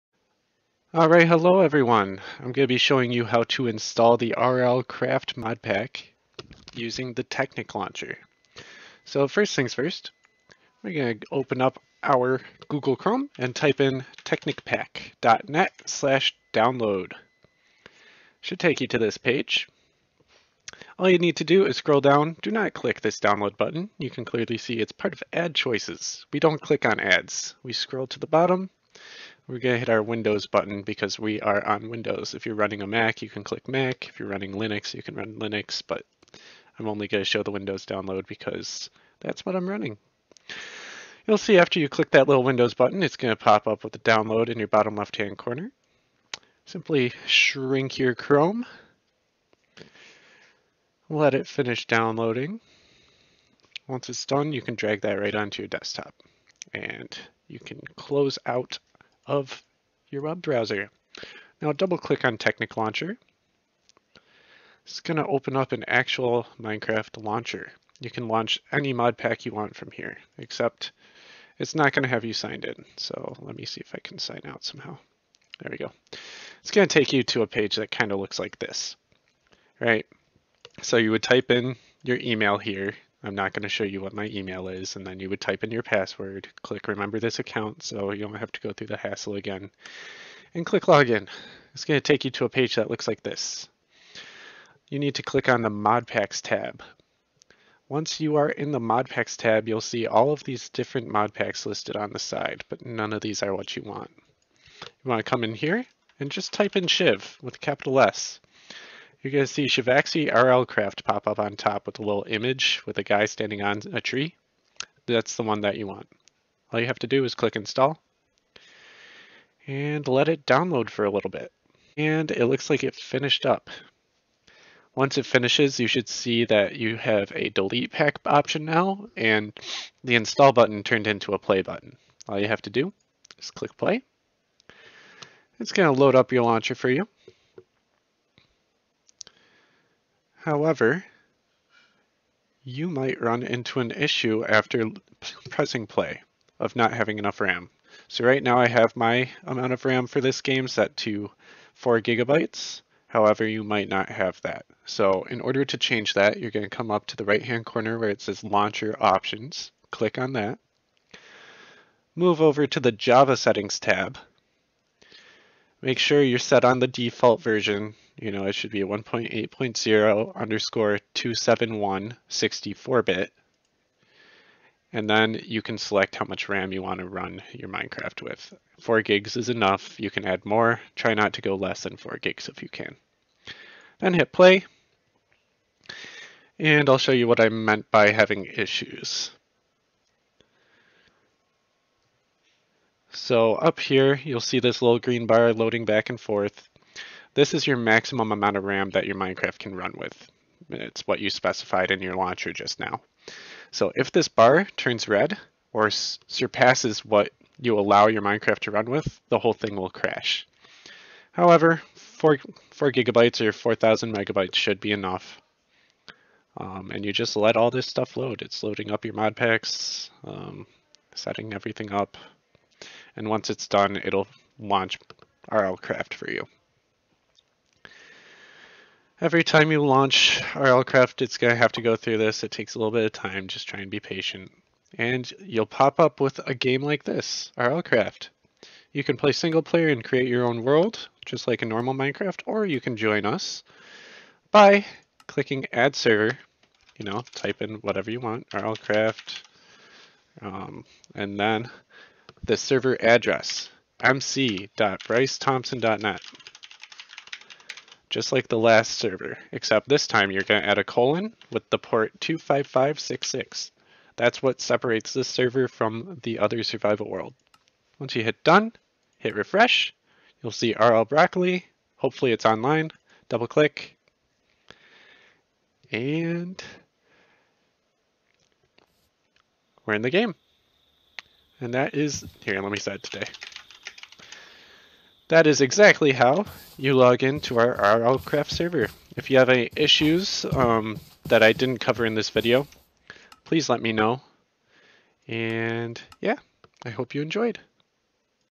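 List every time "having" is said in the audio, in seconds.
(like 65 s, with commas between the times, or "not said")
146 s, 188 s.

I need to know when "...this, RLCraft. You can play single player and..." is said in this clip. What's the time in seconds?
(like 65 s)
237 s.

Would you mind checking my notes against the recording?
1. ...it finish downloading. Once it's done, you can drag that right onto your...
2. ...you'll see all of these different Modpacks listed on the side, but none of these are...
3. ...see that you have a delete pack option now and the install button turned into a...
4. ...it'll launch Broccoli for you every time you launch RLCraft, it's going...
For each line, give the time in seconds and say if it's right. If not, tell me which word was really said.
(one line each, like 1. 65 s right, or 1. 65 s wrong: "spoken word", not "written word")
1. 51 s right
2. 99 s right
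3. 126 s right
4. 224 s wrong: "RLCraft", not "Broccoli".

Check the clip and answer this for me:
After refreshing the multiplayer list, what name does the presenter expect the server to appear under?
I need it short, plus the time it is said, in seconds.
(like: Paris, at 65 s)
RL Broccoli, at 270 s.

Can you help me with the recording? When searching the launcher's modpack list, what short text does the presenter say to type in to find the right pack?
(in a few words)
Shiv.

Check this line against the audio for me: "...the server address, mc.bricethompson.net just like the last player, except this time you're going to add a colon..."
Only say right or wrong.
wrong.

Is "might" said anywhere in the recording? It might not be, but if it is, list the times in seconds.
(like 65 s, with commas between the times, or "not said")
142 s, 153 s.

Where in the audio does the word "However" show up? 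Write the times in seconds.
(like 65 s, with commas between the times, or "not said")
140 s, 153 s, 211 s.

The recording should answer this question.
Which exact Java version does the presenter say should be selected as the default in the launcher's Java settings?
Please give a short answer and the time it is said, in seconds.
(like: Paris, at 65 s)
1.8.0_271 64-bit, at 168 s.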